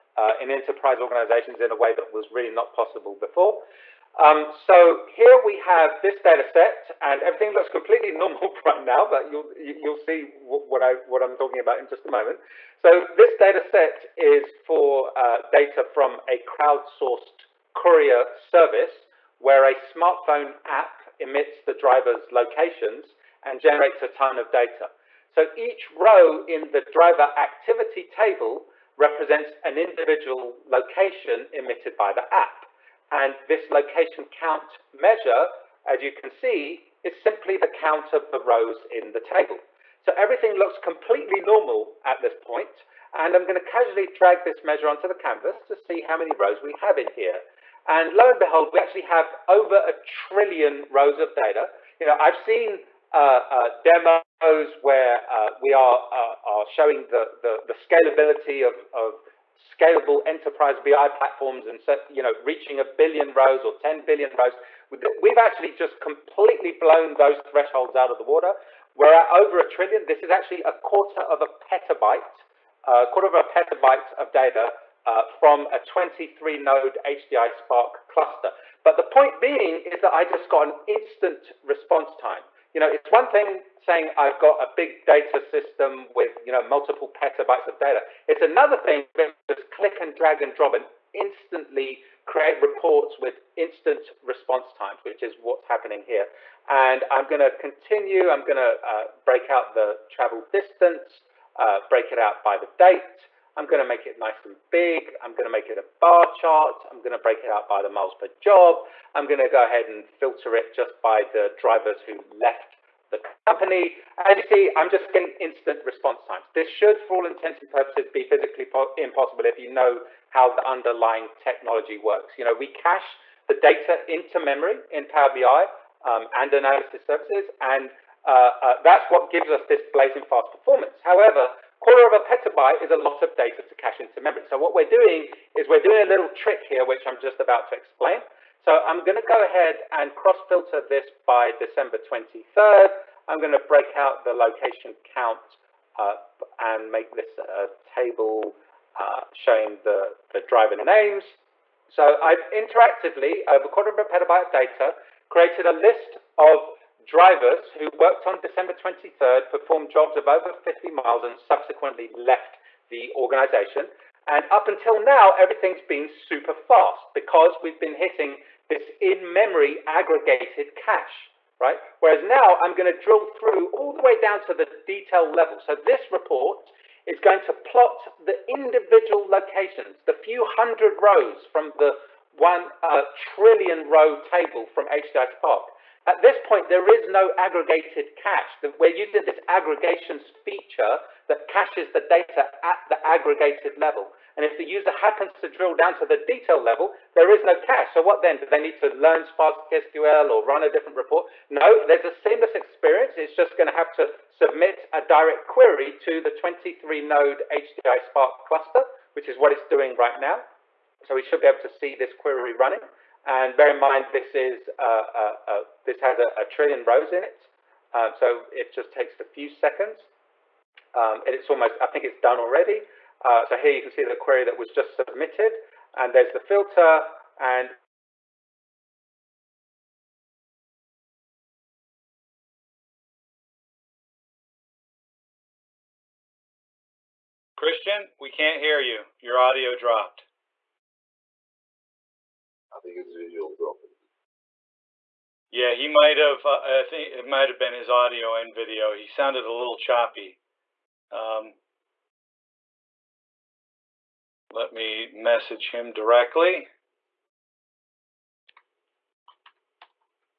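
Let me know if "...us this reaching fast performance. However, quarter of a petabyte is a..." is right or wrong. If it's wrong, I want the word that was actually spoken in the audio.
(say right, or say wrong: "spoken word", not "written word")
wrong: "blazing", not "reaching".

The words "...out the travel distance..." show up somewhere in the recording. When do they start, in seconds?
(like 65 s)
99 s.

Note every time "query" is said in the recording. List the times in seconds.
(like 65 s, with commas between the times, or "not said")
205 s, 212 s, 224 s.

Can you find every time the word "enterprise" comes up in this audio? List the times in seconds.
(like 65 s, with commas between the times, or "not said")
0 s, 60 s.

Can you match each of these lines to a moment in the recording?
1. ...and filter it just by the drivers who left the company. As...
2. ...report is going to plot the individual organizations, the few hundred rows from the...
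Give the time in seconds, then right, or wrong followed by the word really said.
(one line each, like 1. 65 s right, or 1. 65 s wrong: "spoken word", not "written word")
1. 109 s right
2. 176 s wrong: "locations", not "organizations".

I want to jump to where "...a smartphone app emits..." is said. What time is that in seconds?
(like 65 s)
19 s.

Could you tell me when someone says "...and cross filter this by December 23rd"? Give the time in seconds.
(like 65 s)
139 s.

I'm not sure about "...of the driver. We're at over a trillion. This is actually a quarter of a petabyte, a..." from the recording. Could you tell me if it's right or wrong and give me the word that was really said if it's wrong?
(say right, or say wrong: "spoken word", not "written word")
wrong: "water", not "driver".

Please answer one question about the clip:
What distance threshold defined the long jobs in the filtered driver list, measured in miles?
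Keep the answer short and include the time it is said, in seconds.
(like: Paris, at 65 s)
50 miles, at 160 s.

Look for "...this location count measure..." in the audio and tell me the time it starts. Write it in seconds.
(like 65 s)
33 s.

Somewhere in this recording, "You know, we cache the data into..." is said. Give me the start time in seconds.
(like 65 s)
122 s.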